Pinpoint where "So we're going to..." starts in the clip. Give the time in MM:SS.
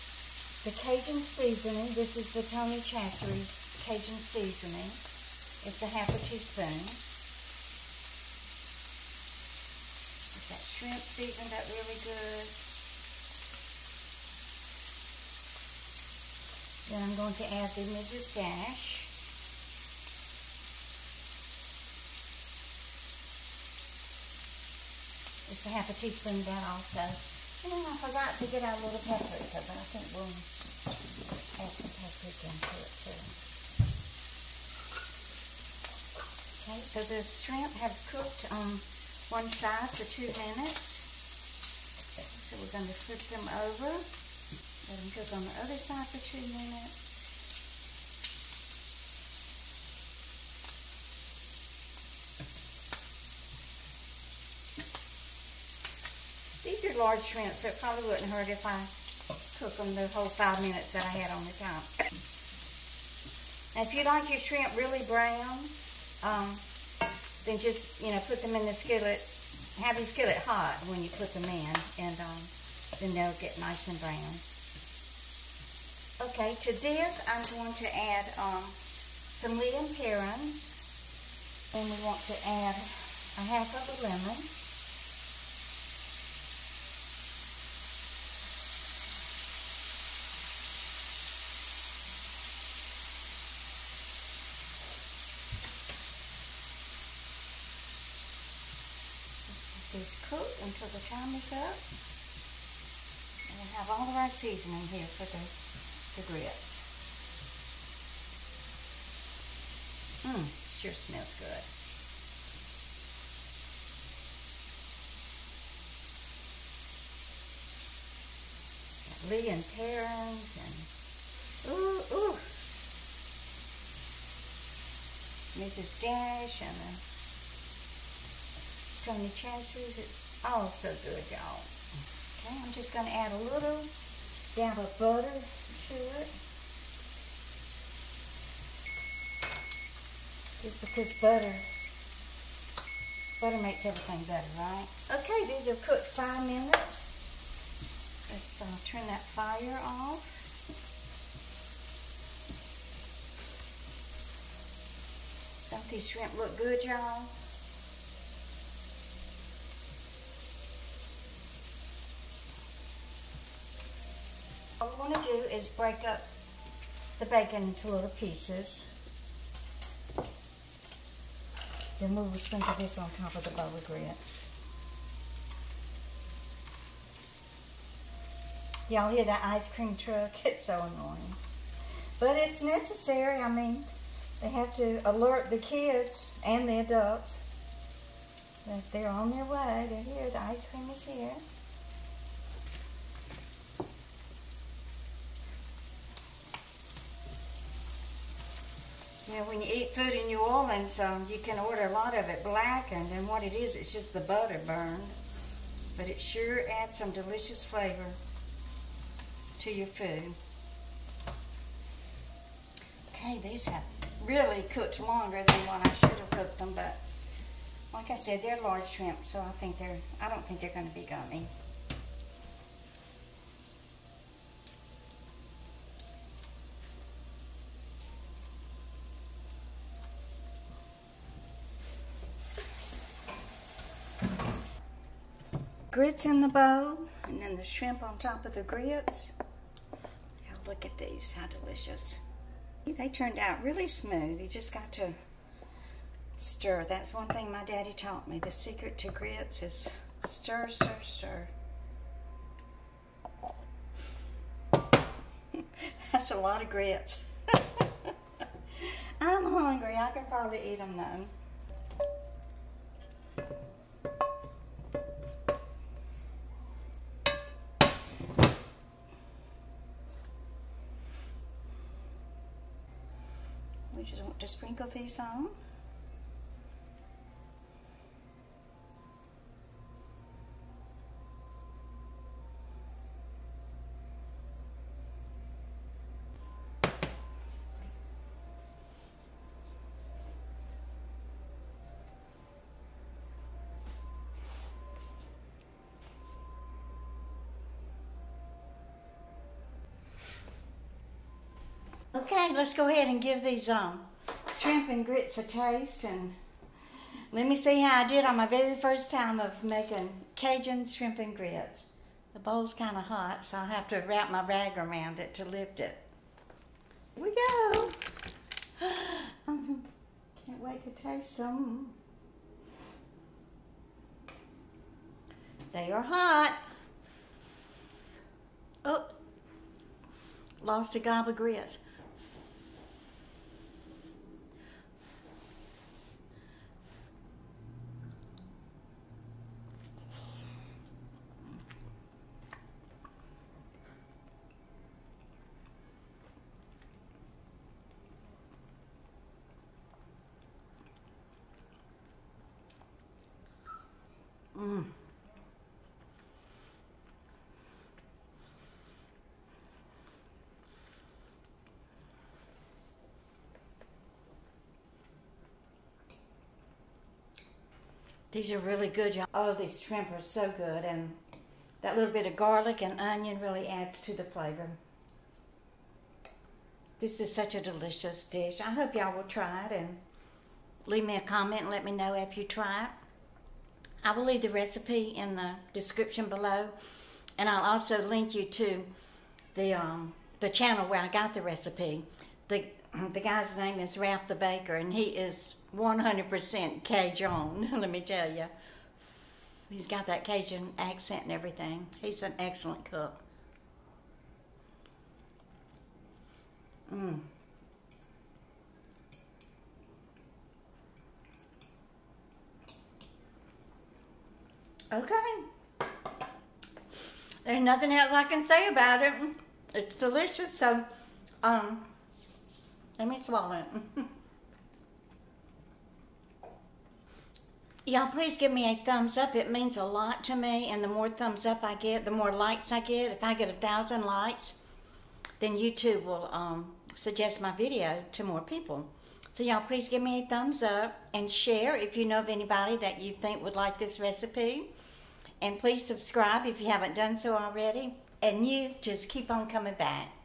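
00:42.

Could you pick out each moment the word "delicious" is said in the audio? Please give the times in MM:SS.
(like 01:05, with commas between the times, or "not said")
03:27, 04:01, 06:17, 06:59.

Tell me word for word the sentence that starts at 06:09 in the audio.
Oh, these shrimp are so good.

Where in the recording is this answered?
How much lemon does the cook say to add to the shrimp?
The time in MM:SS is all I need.
01:22.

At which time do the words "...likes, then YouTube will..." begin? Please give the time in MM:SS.
07:14.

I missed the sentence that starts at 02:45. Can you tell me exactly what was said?
is break up the bacon into little pieces.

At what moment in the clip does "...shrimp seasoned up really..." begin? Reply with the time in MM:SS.
00:10.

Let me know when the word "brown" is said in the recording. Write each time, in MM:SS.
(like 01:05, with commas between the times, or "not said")
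01:05, 01:14.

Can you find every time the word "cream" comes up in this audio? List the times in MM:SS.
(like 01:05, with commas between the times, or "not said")
02:59, 03:10.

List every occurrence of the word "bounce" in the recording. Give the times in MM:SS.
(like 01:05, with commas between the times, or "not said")
not said.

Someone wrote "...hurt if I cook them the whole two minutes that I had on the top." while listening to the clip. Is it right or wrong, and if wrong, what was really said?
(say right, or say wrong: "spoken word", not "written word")
wrong: "five", not "two".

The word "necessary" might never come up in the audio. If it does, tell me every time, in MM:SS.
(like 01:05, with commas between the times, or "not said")
03:02.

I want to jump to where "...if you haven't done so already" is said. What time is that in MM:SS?
07:26.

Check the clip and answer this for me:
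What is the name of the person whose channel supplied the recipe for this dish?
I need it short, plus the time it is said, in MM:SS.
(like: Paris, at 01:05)
Ralph the Baker, at 06:33.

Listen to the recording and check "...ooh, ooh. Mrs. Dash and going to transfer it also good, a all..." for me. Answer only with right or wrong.
right.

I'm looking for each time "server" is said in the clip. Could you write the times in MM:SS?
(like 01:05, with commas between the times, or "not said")
not said.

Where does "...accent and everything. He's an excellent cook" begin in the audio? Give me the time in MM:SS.
06:40.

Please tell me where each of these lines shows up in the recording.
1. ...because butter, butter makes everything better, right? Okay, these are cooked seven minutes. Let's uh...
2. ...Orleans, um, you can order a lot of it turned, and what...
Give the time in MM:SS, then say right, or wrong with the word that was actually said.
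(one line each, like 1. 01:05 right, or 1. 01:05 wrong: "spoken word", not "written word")
1. 02:20 wrong: "five", not "seven"
2. 03:20 wrong: "blackened", not "turned".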